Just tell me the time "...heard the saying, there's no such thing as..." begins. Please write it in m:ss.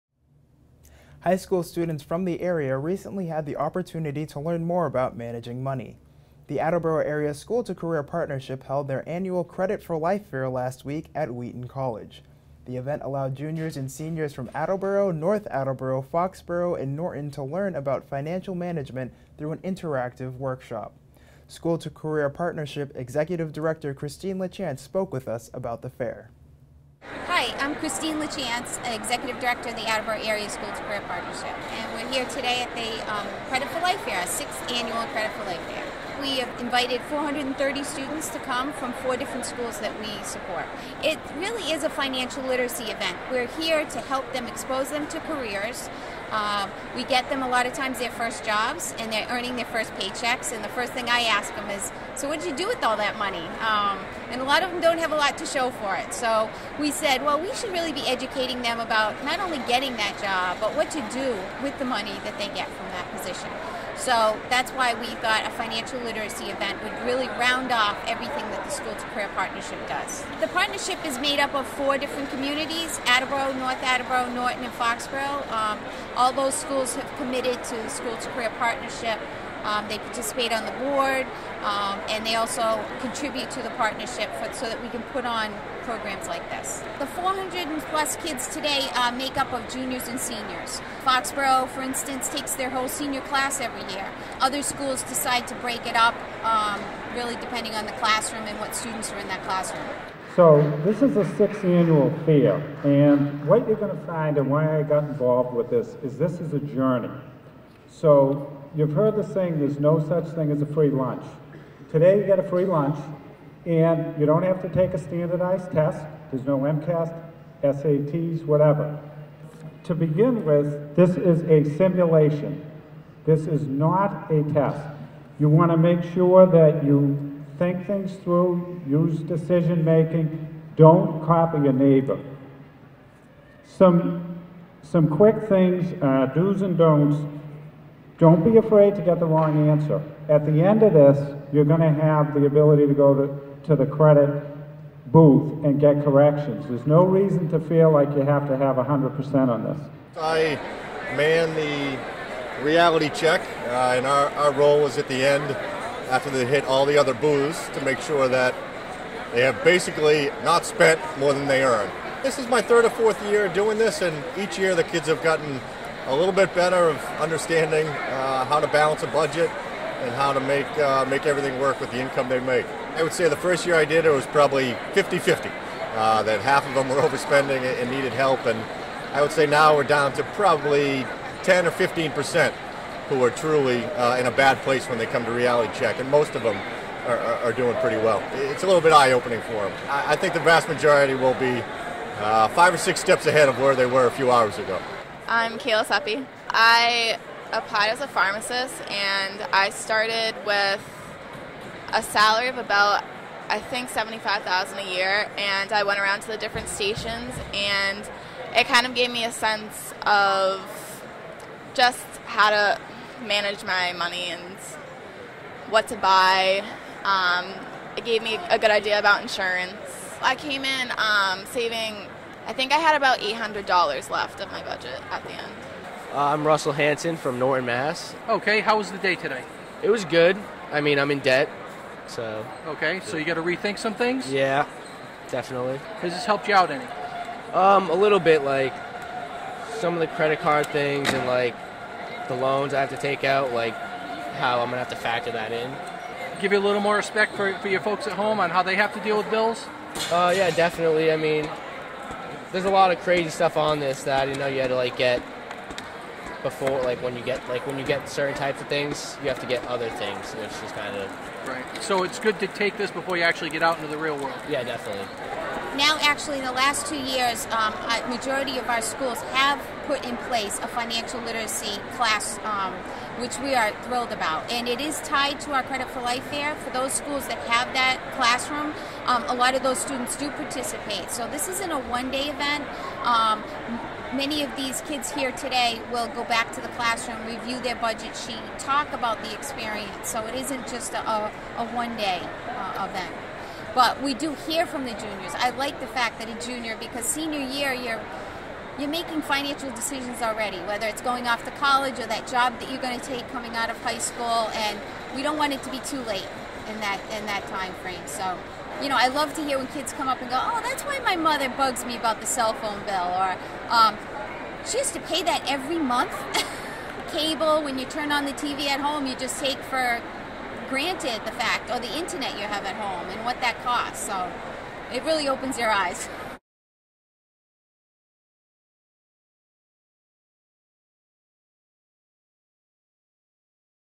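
1:48.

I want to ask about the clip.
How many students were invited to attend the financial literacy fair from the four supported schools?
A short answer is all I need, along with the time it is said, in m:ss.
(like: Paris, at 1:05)
430, at 0:37.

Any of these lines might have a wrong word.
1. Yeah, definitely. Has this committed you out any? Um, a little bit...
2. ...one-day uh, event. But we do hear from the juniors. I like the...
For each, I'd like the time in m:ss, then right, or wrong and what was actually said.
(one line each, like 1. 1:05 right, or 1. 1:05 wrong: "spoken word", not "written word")
1. 3:54 wrong: "helped", not "committed"
2. 4:51 right.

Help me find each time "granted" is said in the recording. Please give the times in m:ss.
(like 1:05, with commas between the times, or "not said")
5:20.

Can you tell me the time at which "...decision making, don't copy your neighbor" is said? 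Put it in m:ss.
2:09.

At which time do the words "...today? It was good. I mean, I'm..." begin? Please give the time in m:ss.
3:49.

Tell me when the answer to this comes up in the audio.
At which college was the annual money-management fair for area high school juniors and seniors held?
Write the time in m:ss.
0:11.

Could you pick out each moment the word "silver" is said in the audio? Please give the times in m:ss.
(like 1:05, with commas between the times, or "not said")
not said.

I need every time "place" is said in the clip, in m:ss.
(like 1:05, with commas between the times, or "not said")
3:04, 4:30.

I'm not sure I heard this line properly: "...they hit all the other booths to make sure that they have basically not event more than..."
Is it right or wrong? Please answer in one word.
wrong.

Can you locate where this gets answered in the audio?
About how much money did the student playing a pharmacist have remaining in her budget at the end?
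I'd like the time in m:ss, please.
3:43.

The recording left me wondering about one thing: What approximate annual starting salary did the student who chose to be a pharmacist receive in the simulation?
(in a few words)
75,000.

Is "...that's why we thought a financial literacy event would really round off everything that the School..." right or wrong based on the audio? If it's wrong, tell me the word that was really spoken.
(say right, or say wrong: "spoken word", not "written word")
right.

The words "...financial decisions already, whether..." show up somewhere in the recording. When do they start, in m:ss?
4:59.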